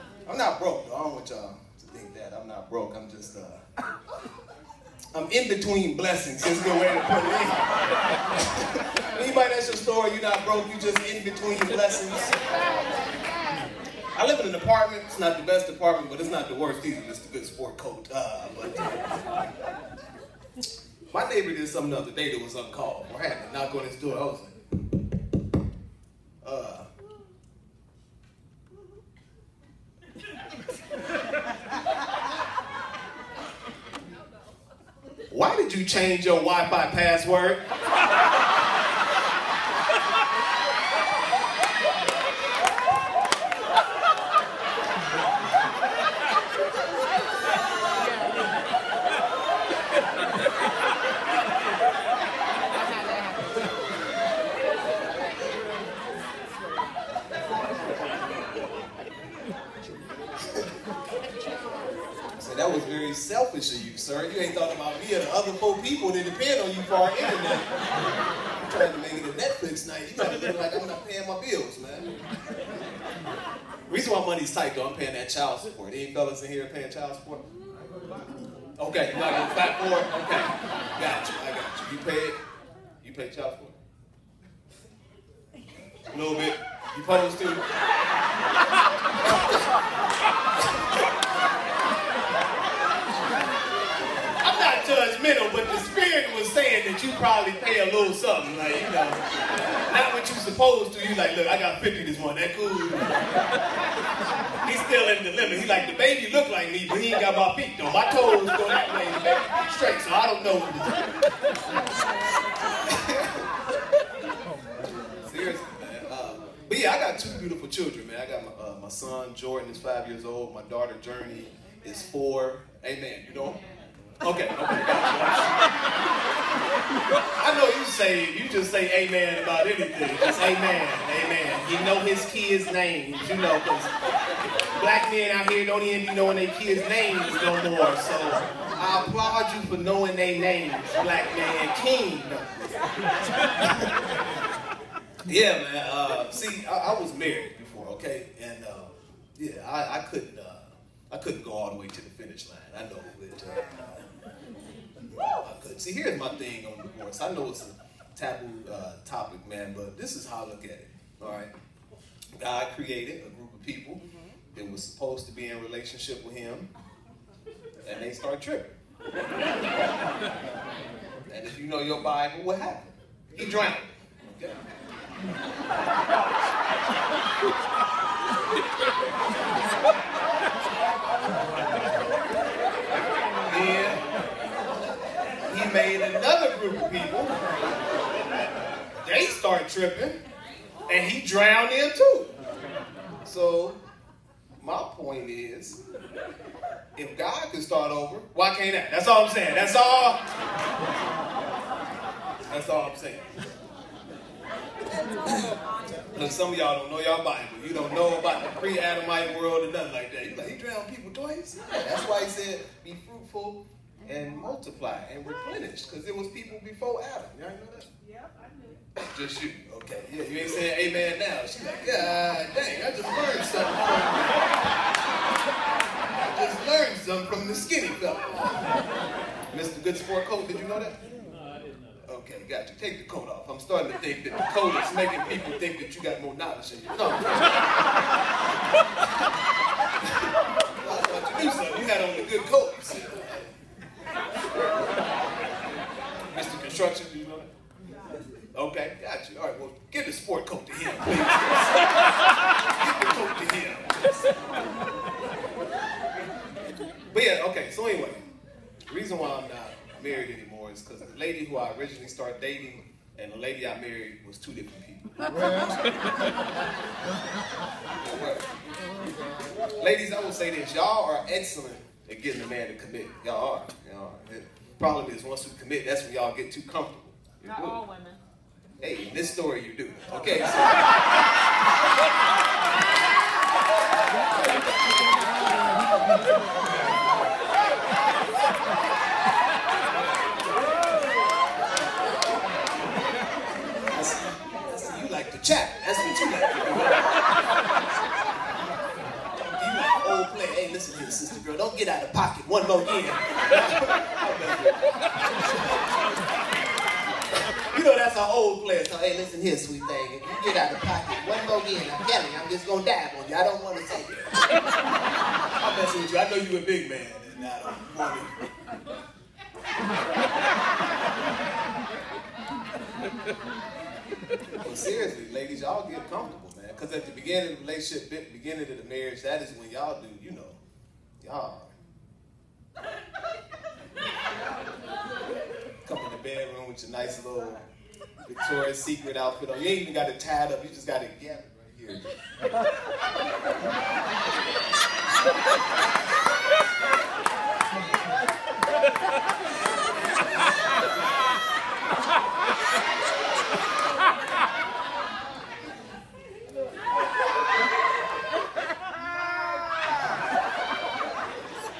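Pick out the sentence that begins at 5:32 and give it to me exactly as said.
Come in the bedroom with your nice little Victoria's Secret outfit on.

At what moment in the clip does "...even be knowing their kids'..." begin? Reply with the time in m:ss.
2:15.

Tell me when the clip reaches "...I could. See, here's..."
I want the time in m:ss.
2:35.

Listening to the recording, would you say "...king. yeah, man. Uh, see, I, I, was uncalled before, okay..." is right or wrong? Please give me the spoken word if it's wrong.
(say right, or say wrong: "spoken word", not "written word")
wrong: "married", not "uncalled".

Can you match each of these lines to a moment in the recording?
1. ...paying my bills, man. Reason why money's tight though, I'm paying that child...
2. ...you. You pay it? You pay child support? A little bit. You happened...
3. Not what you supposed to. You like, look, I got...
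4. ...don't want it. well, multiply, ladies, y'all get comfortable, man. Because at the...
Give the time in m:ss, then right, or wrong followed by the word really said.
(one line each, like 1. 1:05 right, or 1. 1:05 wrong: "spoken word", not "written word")
1. 1:11 right
2. 1:21 wrong: "supposed", not "happened"
3. 1:39 right
4. 5:17 wrong: "seriously", not "multiply".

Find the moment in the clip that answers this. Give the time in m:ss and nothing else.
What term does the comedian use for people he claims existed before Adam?
3:28.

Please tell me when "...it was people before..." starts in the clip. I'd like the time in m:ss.
3:36.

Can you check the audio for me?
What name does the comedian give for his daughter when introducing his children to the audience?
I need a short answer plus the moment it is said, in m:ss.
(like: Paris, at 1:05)
Journey, at 2:01.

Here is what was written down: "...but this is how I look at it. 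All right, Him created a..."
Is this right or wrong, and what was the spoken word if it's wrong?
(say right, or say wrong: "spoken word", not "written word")
wrong: "God", not "Him".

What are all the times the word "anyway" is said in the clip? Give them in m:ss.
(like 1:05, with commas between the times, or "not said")
4:17.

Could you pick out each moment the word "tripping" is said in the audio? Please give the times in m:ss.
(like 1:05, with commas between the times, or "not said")
2:48, 3:09.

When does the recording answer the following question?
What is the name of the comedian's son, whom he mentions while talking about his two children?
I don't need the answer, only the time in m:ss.
1:59.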